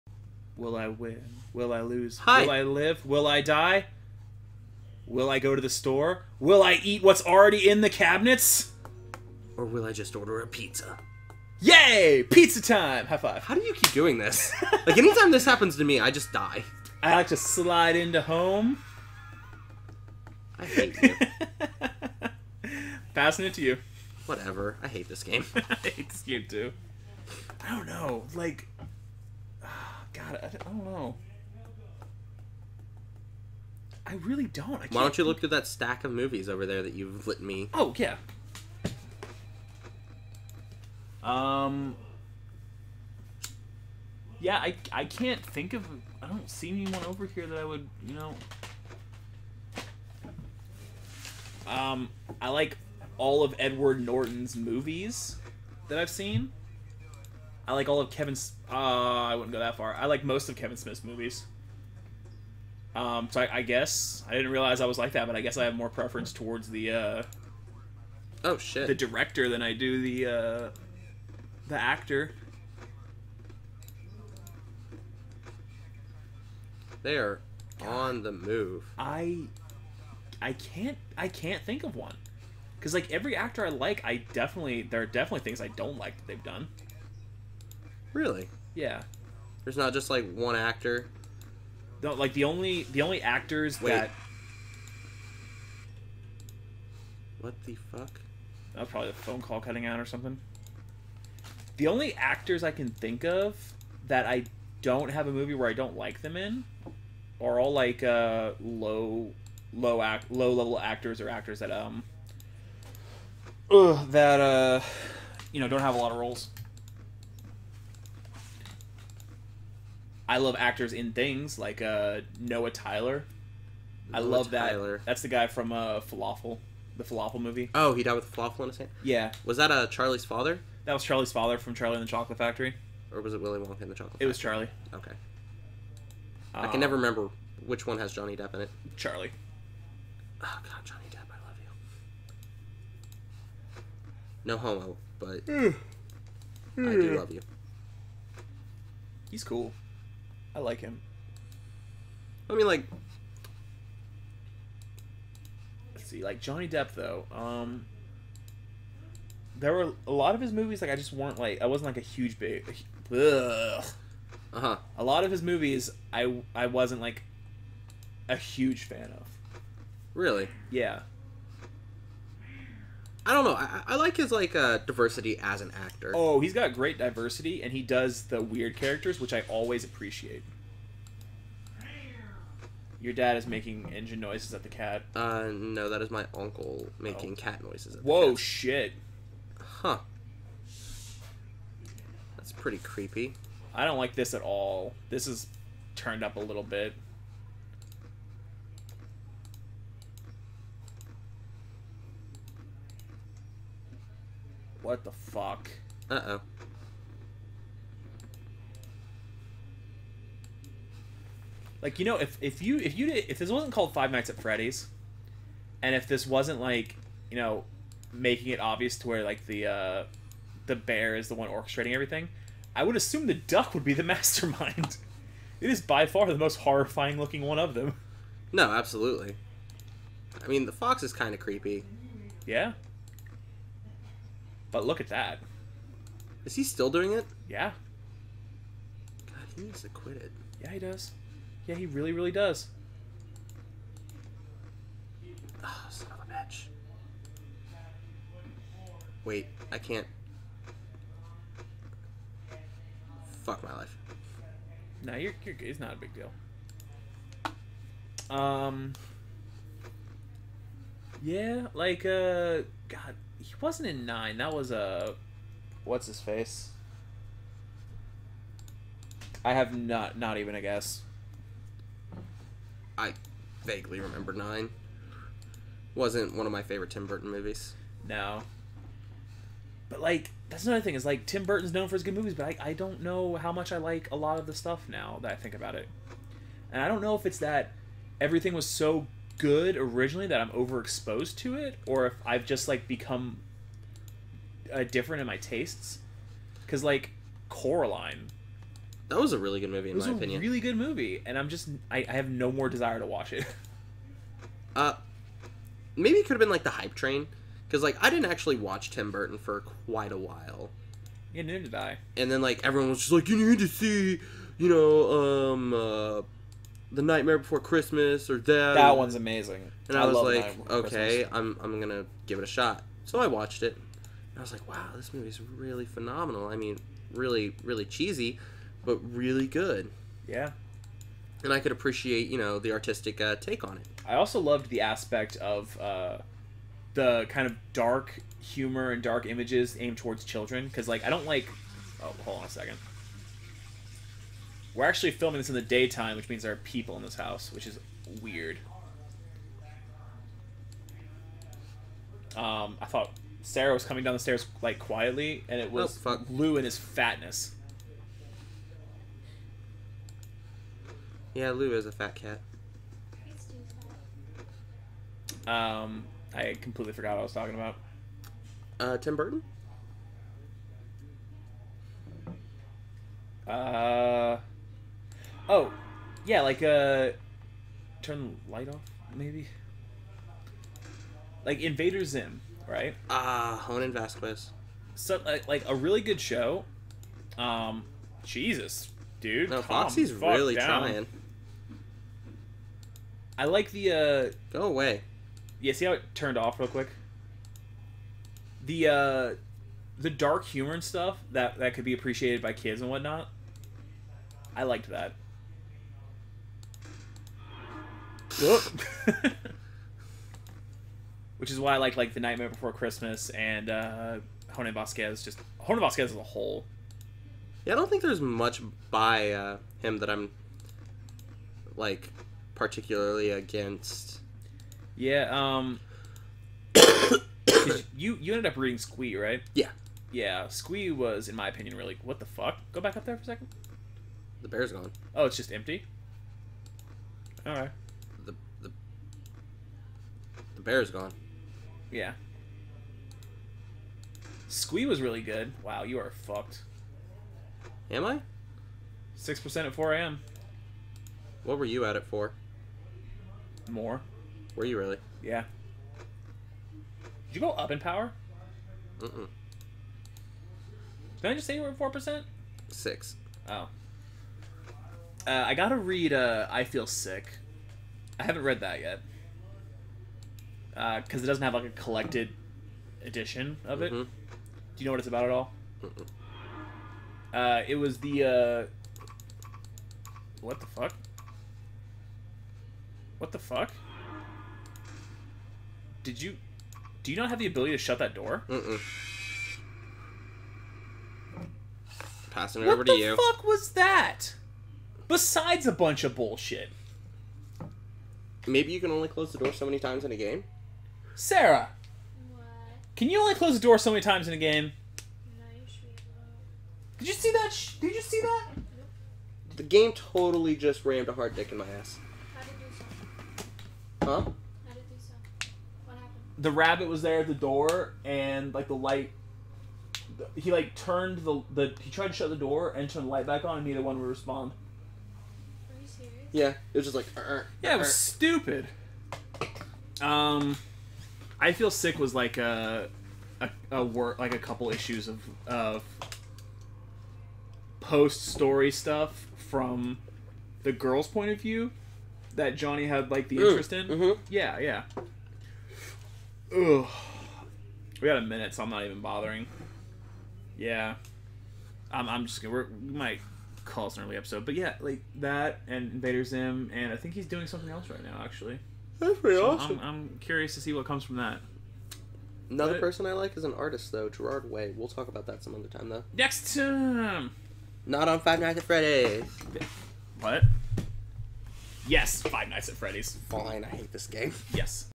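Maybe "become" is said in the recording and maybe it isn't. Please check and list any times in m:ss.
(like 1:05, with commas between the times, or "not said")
4:52.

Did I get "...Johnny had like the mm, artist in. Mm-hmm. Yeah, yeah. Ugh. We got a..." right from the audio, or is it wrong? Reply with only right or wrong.
wrong.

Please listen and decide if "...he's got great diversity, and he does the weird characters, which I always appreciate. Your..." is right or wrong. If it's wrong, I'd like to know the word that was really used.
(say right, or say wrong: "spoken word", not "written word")
right.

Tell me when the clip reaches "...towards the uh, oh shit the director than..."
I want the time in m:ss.
1:06.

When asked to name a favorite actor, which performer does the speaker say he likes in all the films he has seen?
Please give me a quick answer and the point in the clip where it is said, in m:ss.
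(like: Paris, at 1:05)
Edward Norton, at 0:53.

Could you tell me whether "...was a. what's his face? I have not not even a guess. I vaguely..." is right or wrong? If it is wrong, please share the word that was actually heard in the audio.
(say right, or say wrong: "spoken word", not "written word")
right.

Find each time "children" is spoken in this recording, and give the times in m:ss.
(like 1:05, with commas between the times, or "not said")
5:40.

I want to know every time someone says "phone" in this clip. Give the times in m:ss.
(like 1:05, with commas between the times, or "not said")
1:39.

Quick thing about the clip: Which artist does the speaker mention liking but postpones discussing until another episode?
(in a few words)
Gerard Way.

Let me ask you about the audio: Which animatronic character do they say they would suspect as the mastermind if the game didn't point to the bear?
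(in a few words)
The duck.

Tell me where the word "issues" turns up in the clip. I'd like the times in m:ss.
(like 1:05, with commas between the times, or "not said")
8:54.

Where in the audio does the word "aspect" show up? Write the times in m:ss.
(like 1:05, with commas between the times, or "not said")
5:34.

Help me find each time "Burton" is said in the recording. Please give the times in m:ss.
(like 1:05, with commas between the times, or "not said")
4:37, 4:41, 5:09, 6:09.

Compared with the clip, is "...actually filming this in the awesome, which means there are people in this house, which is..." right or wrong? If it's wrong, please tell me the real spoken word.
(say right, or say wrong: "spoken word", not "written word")
wrong: "daytime", not "awesome".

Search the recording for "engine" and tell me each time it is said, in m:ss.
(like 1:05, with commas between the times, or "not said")
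3:03.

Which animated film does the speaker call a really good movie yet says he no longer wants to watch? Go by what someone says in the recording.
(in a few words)
Coraline.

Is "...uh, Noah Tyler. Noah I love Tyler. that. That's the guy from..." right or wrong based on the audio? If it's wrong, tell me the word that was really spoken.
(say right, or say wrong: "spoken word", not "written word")
right.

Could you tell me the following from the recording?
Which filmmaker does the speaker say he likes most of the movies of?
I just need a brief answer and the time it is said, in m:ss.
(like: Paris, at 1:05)
Kevin Smith, at 1:00.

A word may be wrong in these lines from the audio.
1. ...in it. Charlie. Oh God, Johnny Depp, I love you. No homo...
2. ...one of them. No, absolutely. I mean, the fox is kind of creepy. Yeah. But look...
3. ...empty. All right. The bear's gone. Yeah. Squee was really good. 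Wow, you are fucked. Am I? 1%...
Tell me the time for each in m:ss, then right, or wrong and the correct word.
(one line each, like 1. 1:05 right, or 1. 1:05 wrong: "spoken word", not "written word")
1. 2:18 right
2. 3:47 right
3. 7:15 wrong: "6", not "1".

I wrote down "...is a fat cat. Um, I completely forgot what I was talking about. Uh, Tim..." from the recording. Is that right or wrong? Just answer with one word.
right.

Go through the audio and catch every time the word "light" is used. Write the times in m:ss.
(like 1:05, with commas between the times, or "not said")
6:18, 8:38, 8:43.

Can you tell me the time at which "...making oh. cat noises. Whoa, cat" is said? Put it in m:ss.
3:06.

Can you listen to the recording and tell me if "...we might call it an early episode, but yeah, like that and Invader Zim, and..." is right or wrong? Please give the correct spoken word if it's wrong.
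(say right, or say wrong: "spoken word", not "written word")
right.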